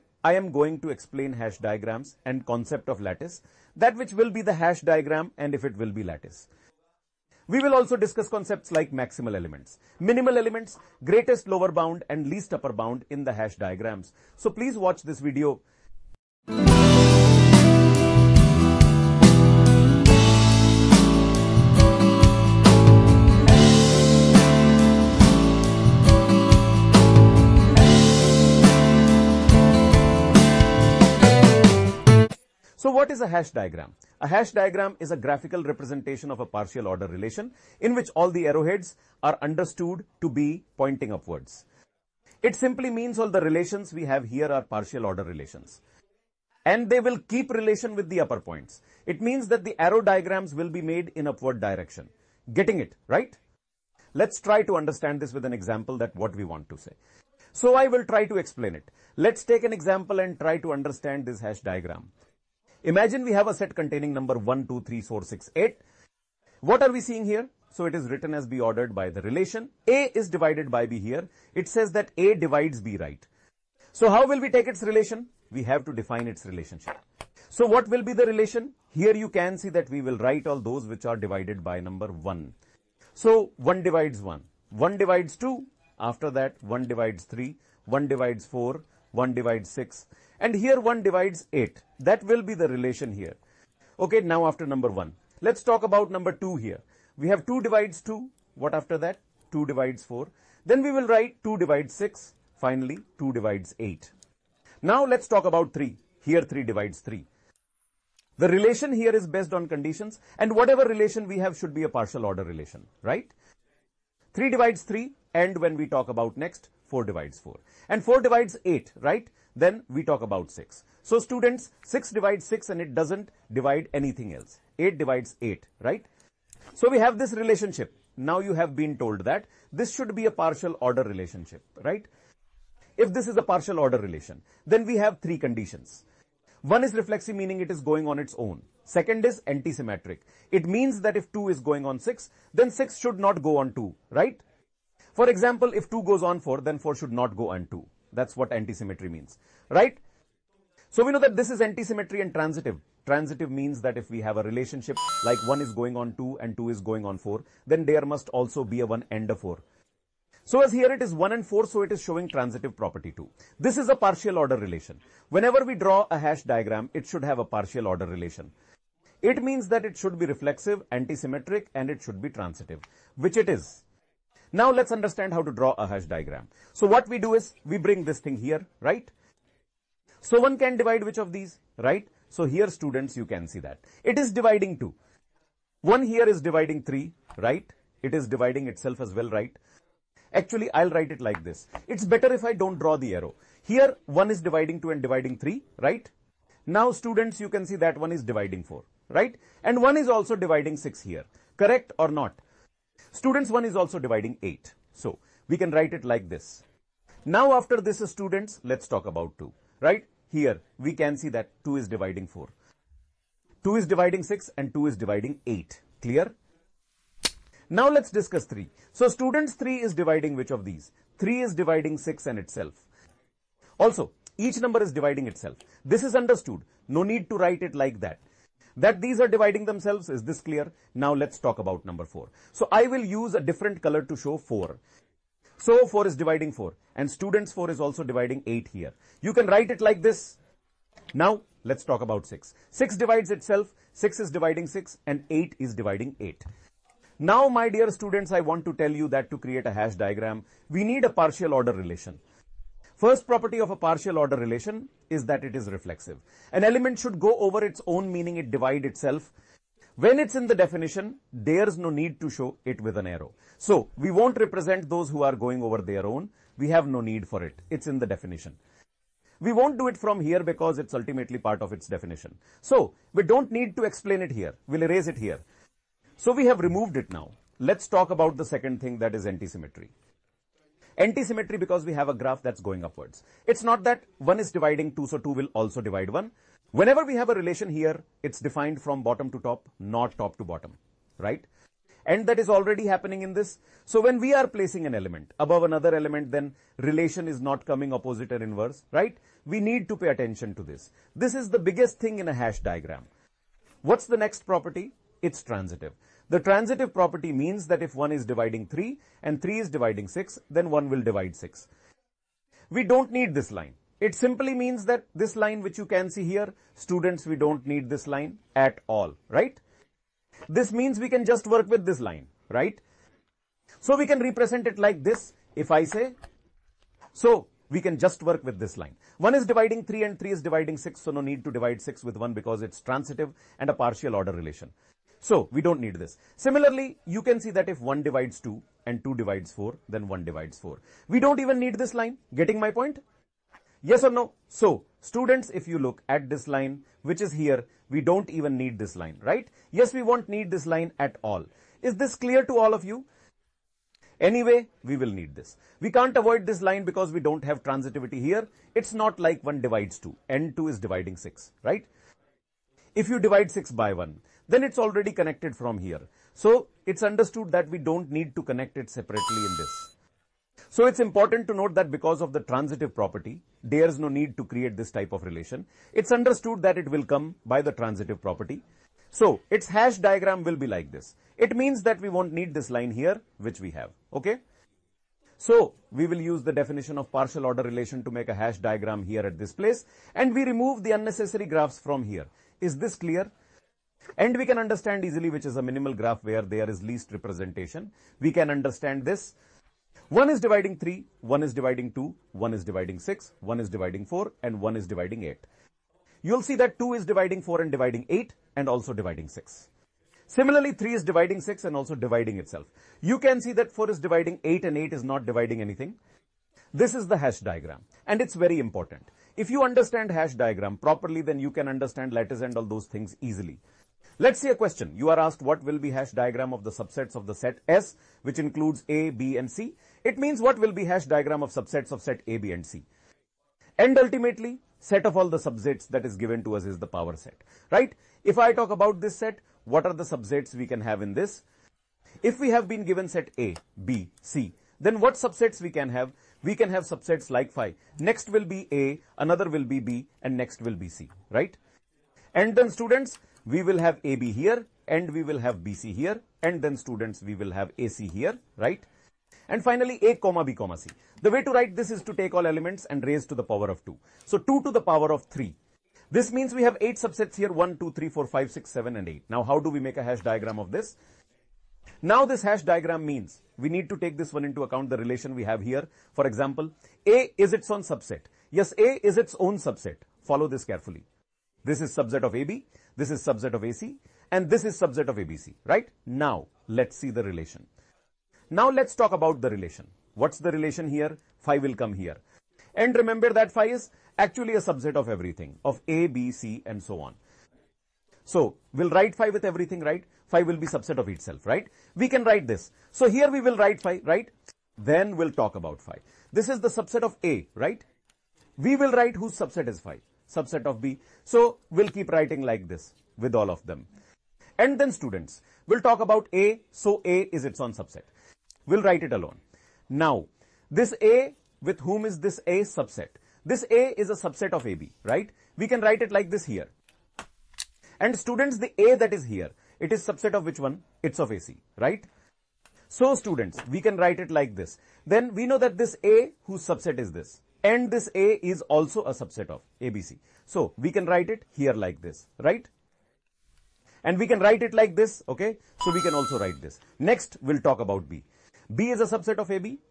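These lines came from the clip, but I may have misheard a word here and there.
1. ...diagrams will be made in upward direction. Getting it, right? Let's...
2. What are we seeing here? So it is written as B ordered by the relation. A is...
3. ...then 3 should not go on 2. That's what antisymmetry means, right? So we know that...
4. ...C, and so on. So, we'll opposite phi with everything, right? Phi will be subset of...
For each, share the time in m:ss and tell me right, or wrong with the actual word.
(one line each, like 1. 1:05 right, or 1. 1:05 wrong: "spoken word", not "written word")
1. 0:50 right
2. 1:06 right
3. 2:26 wrong: "4", not "3"
4. 8:16 wrong: "write", not "opposite".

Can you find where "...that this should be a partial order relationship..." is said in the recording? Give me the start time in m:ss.
2:09.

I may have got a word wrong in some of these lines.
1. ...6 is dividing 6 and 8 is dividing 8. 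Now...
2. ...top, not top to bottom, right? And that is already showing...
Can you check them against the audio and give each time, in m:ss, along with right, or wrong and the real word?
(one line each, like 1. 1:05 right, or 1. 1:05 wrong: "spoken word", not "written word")
1. 4:03 right
2. 4:49 wrong: "happening", not "showing".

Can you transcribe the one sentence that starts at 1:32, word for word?
That will be the relation here.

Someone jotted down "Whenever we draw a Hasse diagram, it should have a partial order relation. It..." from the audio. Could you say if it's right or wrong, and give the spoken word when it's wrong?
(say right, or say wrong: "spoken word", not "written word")
right.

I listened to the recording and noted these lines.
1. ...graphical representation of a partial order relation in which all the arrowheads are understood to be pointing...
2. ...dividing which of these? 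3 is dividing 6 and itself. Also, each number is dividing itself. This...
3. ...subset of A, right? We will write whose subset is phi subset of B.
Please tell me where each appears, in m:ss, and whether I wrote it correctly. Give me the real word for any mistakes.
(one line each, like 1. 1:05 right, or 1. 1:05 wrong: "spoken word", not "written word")
1. 0:35 right
2. 3:39 right
3. 8:26 right.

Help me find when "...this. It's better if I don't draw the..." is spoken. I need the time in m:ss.
3:11.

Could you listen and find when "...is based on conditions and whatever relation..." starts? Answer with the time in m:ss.
1:49.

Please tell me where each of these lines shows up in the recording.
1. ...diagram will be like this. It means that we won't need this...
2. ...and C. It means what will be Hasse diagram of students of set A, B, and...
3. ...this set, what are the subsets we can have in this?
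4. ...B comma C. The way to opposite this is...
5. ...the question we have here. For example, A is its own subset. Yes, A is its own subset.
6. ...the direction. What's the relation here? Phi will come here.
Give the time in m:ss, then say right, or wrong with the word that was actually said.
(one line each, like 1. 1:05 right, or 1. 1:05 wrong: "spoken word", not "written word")
1. 6:19 right
2. 7:09 wrong: "subsets", not "students"
3. 7:19 right
4. 7:40 wrong: "write", not "opposite"
5. 7:54 wrong: "relation", not "question"
6. 8:09 wrong: "relation", not "direction".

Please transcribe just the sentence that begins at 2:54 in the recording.
Now let's understand how to draw a Hasse diagram.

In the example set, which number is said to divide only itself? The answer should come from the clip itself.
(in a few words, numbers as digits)
6.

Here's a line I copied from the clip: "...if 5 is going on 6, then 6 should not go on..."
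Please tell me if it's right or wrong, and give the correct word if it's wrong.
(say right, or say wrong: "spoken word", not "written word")
wrong: "2", not "5".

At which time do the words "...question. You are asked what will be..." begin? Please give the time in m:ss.
7:04.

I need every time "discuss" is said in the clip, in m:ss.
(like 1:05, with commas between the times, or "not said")
0:07, 3:38.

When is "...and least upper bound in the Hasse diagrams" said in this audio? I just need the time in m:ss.
0:12.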